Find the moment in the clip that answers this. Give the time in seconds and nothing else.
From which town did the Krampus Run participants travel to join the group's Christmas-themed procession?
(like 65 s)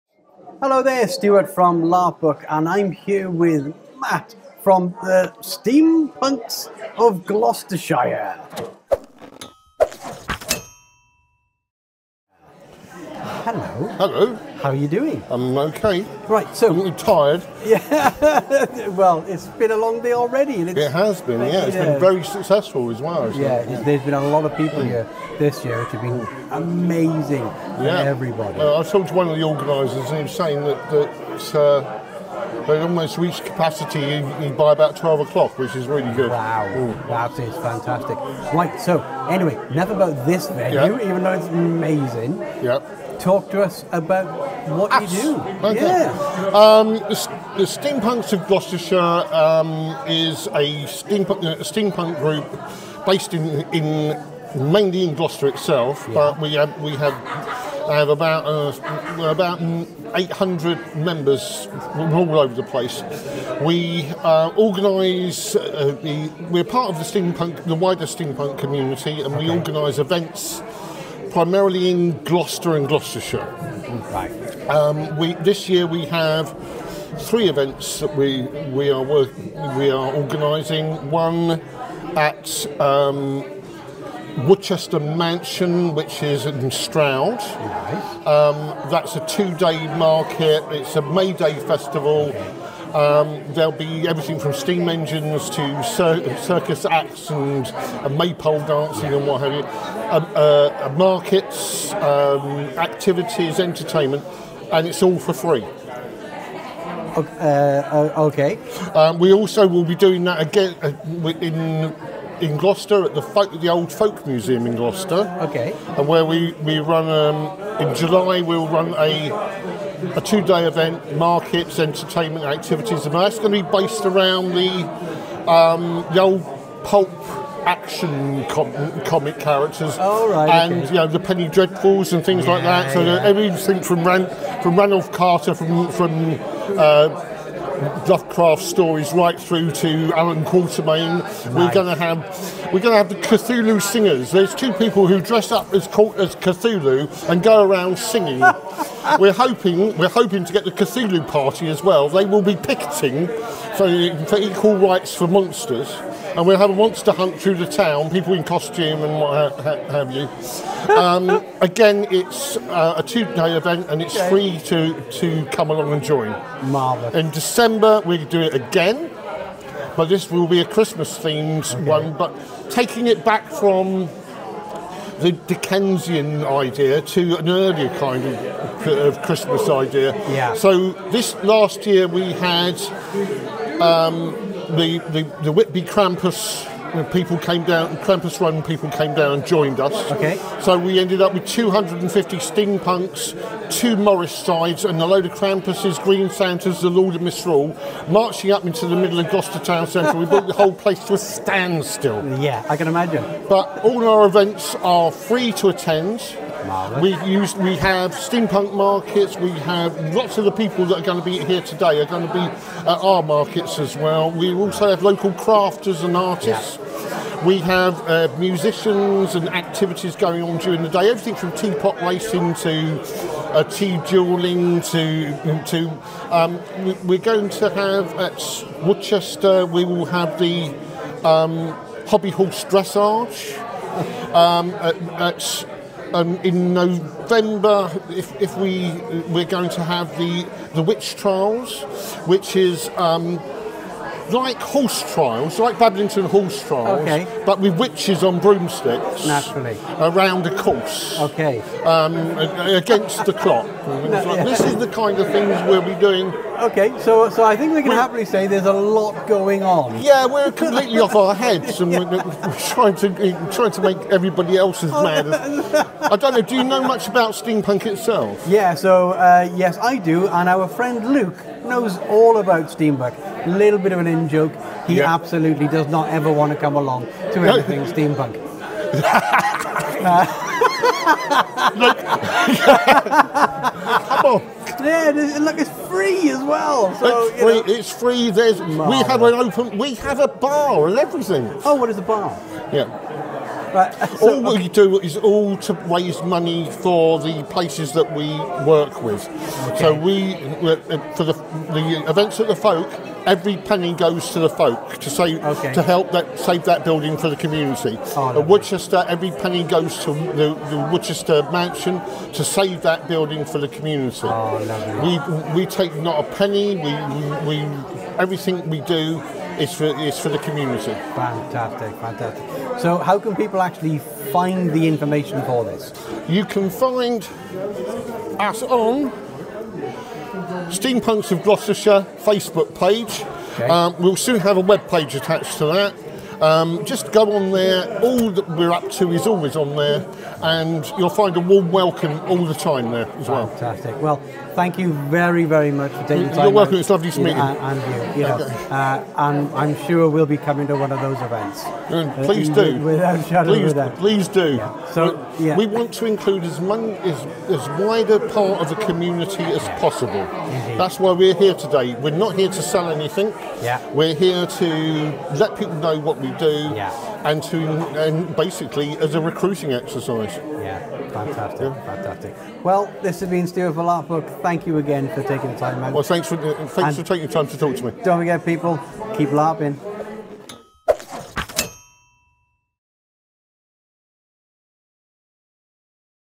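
185 s.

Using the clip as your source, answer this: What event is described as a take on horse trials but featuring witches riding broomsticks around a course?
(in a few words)
the witch trials.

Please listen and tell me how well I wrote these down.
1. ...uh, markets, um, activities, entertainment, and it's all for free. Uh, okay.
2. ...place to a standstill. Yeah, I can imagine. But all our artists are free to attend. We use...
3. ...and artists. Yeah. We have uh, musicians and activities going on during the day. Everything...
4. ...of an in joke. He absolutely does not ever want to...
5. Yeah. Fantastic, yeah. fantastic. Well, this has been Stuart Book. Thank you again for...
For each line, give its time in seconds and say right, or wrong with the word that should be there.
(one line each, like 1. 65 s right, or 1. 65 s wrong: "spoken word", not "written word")
1. 100 s right
2. 200 s wrong: "events", not "artists"
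3. 216 s right
4. 273 s right
5. 370 s right.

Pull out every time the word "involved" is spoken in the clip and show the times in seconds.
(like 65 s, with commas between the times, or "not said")
not said.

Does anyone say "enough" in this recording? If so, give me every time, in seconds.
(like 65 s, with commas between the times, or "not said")
39 s.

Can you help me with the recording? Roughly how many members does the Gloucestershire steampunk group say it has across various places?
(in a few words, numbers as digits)
800.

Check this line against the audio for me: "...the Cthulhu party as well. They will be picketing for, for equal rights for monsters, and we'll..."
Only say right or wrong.
right.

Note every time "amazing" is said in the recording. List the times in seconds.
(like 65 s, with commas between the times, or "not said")
26 s, 41 s.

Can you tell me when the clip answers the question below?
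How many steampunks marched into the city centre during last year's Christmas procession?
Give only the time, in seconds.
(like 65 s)
191 s.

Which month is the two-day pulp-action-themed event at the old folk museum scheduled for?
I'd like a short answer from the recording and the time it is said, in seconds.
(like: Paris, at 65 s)
July, at 117 s.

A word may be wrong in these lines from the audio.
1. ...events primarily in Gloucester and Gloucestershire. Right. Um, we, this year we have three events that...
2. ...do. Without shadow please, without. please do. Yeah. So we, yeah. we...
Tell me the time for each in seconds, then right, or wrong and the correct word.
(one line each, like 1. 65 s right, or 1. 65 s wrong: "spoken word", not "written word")
1. 69 s right
2. 352 s right.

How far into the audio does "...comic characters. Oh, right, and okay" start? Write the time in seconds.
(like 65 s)
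129 s.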